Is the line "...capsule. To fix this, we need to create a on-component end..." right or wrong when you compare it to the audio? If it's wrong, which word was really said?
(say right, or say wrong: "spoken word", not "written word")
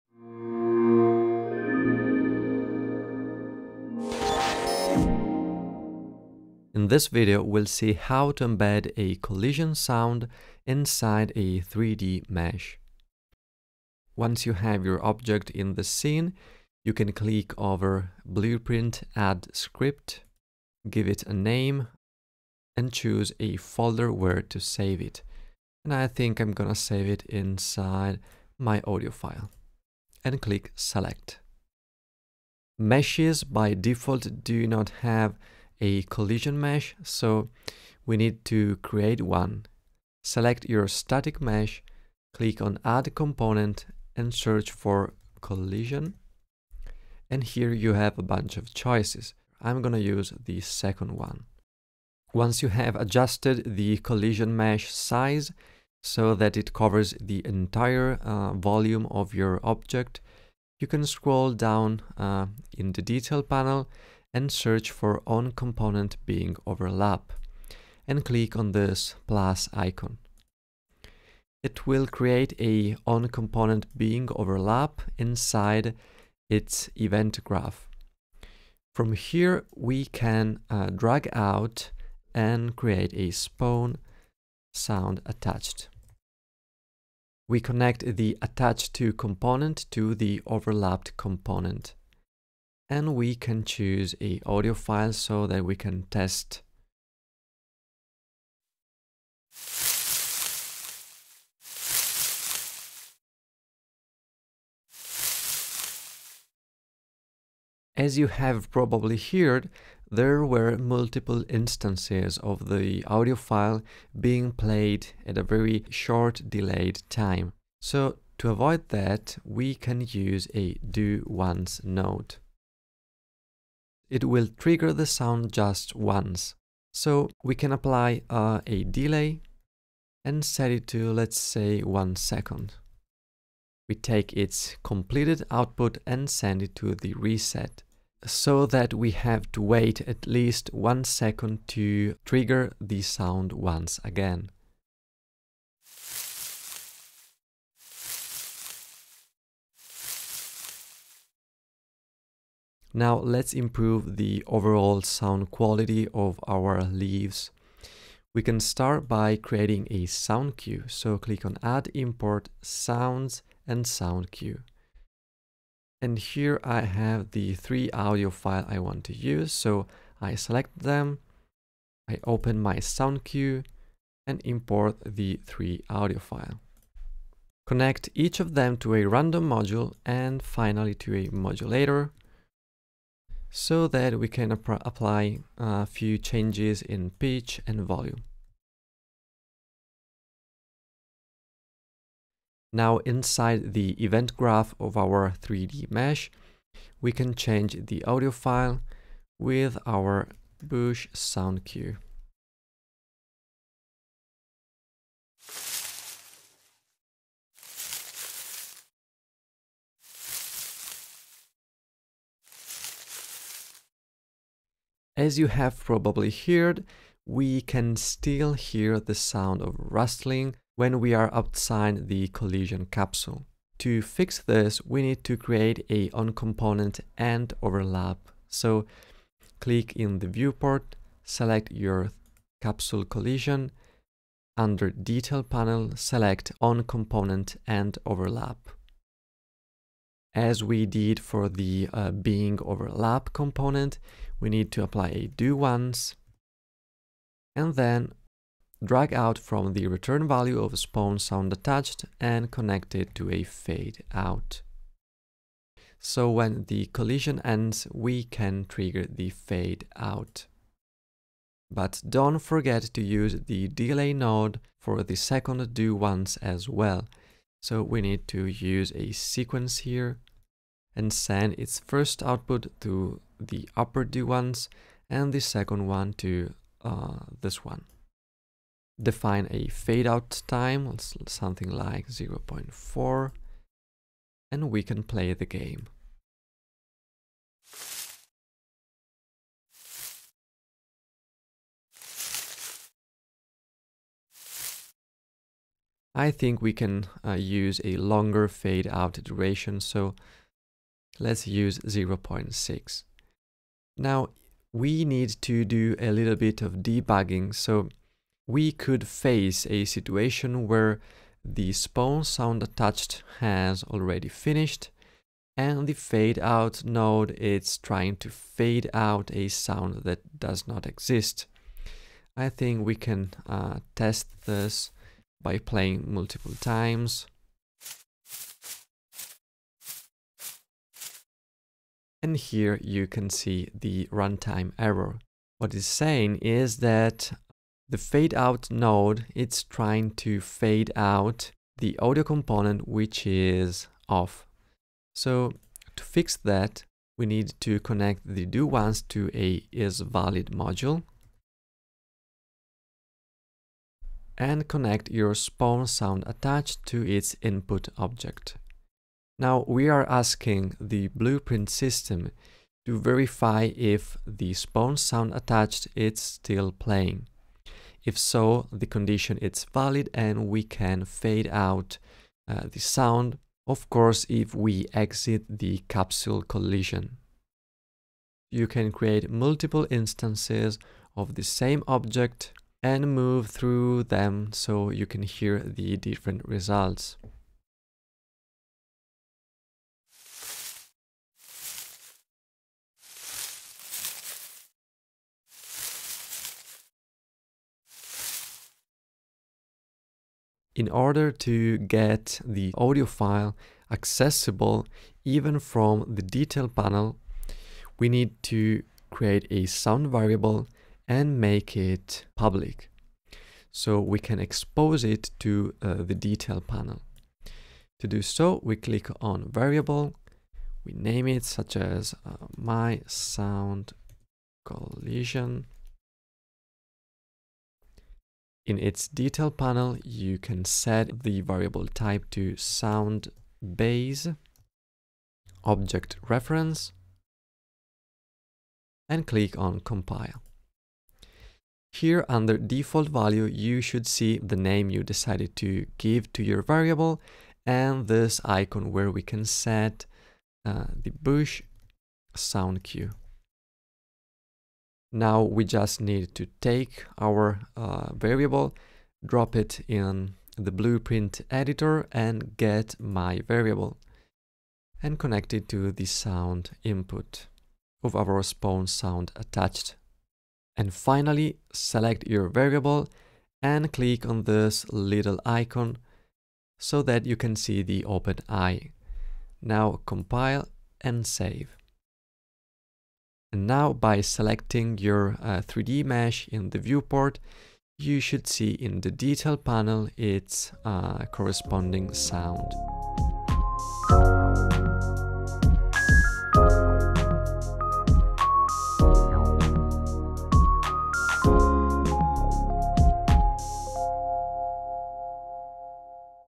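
right.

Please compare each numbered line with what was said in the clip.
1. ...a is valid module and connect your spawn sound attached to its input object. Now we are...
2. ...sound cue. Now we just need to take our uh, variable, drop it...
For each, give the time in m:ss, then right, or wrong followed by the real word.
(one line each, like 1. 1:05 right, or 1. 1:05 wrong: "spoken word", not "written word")
1. 5:49 right
2. 7:32 right.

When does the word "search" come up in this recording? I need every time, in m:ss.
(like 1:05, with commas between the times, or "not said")
0:44, 1:04.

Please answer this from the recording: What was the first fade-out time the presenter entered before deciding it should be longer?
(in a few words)
0.4.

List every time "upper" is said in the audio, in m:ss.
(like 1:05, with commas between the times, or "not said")
4:33.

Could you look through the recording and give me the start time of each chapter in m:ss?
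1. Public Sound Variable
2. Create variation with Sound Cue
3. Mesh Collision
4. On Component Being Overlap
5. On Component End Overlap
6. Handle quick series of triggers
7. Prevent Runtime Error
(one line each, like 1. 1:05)
1. 6:40
2. 2:32
3. 0:32
4. 1:11
5. 3:34
6. 1:47
7. 5:03.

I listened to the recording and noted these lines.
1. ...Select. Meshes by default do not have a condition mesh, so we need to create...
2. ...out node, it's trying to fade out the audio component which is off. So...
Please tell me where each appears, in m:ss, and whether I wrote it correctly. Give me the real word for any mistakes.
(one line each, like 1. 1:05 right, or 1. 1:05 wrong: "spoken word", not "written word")
1. 0:30 wrong: "collision", not "condition"
2. 5:38 right.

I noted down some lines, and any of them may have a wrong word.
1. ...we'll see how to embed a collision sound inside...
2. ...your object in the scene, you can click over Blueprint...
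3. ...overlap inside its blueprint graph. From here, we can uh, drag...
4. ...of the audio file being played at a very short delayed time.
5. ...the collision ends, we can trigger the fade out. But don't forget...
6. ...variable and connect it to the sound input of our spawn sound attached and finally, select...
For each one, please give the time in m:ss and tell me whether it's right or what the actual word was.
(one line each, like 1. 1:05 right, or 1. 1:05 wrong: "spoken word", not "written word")
1. 0:07 right
2. 0:14 right
3. 1:14 wrong: "event", not "blueprint"
4. 1:52 right
5. 4:16 right
6. 7:43 right.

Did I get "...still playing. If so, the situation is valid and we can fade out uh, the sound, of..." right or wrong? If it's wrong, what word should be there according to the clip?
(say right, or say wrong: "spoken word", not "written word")
wrong: "condition", not "situation".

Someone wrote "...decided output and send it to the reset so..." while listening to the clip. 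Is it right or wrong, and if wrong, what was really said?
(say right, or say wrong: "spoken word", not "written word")
wrong: "completed", not "decided".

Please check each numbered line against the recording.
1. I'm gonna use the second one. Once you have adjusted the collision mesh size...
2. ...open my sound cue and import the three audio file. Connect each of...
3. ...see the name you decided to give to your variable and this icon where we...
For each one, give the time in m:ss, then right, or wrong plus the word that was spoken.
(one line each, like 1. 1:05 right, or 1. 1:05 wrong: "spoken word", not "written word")
1. 0:49 right
2. 2:52 right
3. 7:24 right.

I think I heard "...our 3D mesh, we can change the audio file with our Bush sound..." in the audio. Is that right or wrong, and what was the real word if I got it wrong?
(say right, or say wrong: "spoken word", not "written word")
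right.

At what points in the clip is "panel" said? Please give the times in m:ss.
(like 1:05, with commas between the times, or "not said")
1:03, 3:55, 6:46, 6:56, 7:09, 8:09.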